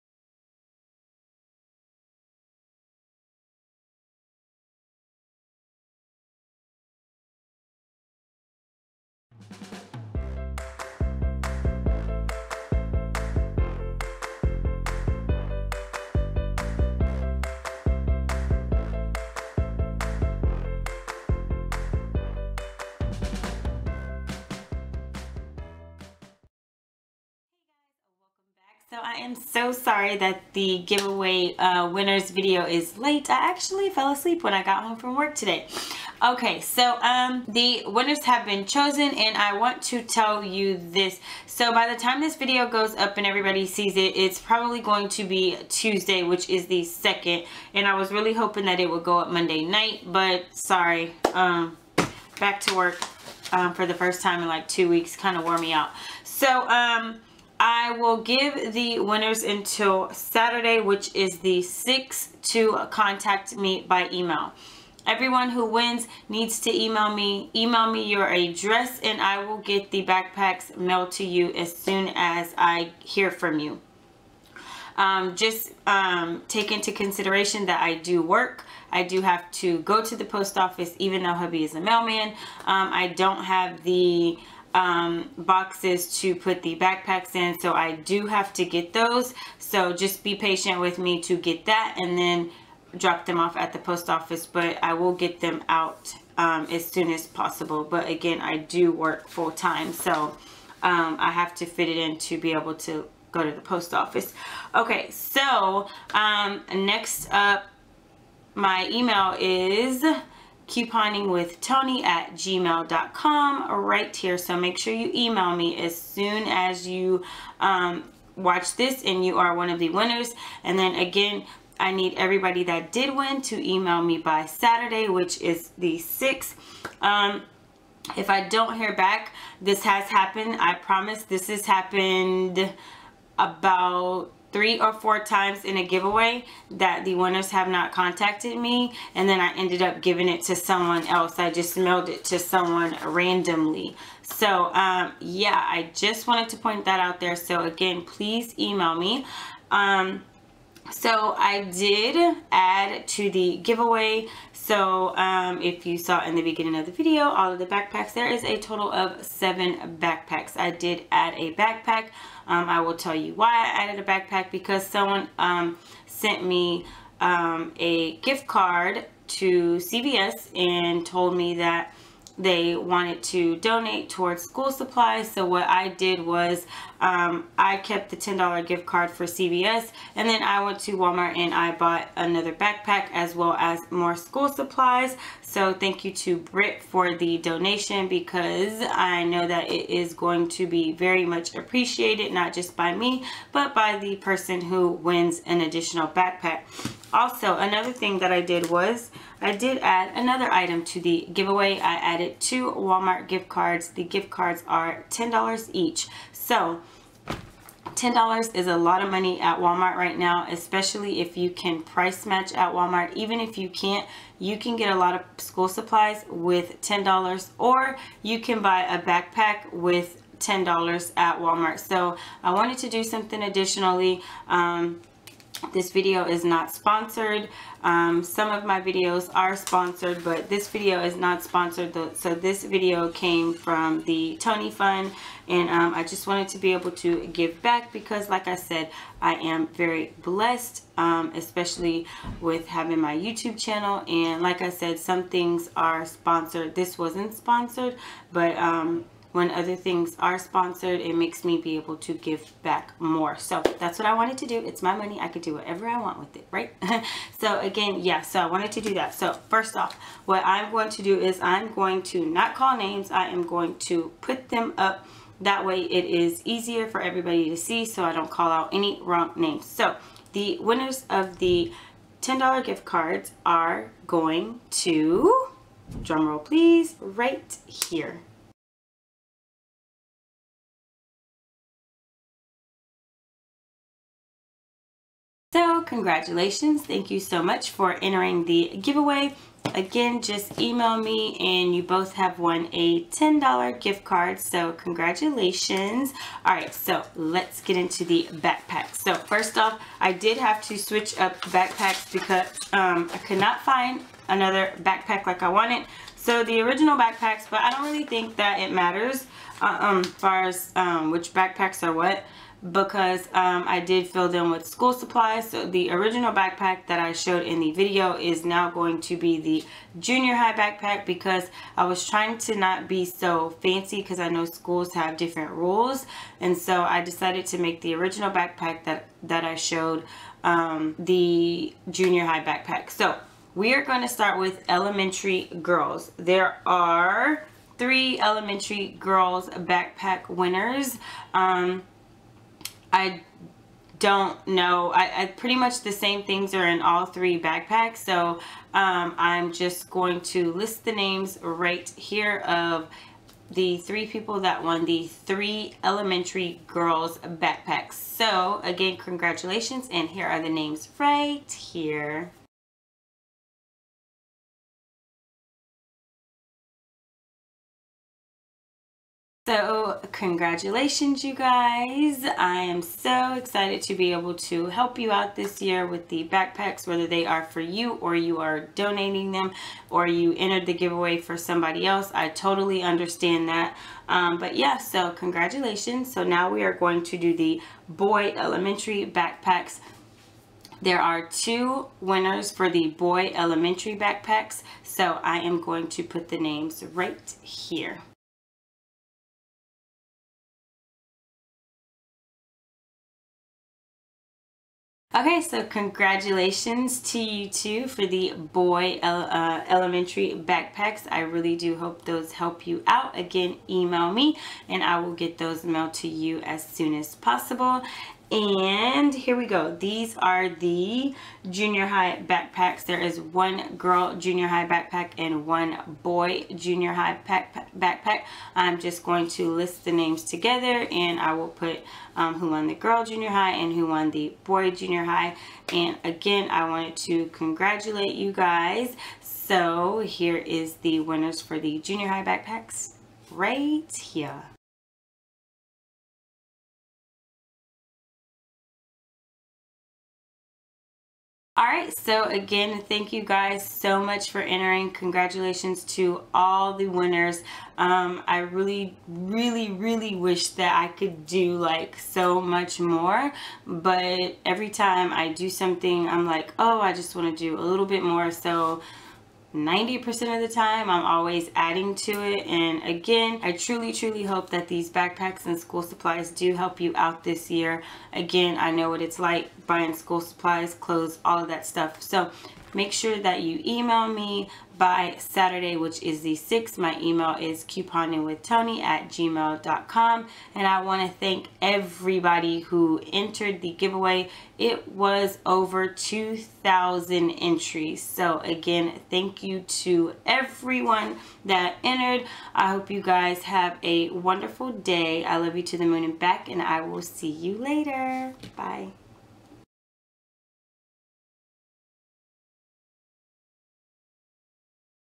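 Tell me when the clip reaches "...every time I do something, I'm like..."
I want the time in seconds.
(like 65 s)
464 s.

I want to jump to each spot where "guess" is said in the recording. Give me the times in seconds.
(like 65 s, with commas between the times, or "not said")
not said.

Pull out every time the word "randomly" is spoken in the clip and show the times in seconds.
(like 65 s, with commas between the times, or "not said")
143 s.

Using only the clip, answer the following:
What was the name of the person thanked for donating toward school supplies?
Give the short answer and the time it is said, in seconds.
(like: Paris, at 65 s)
Britt, at 186 s.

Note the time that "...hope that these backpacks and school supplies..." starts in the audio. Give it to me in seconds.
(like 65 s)
474 s.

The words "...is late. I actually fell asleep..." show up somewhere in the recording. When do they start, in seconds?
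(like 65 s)
32 s.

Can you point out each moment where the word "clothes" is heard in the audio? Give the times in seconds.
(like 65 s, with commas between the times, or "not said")
480 s.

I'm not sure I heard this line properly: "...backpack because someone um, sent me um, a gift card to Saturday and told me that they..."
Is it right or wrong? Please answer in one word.
wrong.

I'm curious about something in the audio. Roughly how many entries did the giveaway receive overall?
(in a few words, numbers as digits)
over 2,000.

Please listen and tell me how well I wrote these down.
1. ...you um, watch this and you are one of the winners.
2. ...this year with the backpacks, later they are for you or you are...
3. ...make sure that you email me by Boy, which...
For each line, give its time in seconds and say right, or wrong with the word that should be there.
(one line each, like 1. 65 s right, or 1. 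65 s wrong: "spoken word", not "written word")
1. 116 s right
2. 375 s wrong: "whether", not "later"
3. 482 s wrong: "Saturday", not "Boy".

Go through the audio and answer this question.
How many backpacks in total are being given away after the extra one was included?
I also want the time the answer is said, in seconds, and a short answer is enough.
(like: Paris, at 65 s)
7, at 159 s.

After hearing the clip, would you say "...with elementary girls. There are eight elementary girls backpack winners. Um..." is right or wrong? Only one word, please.
wrong.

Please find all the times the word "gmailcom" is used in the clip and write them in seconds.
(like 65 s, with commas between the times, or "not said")
112 s, 489 s.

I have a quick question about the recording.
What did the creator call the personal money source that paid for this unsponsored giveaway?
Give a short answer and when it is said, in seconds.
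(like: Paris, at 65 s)
Toni Fund, at 234 s.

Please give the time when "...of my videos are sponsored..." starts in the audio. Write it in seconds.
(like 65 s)
228 s.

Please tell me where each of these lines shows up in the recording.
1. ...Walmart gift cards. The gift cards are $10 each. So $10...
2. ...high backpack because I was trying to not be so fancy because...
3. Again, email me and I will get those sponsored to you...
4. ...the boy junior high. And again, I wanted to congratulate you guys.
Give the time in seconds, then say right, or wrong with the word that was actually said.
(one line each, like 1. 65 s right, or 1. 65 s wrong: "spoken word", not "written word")
1. 202 s right
2. 320 s right
3. 413 s wrong: "mailed", not "sponsored"
4. 434 s right.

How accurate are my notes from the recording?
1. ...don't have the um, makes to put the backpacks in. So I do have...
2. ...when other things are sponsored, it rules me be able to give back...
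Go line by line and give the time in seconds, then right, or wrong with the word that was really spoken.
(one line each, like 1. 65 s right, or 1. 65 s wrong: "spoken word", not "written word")
1. 83 s wrong: "boxes", not "makes"
2. 249 s wrong: "makes", not "rules".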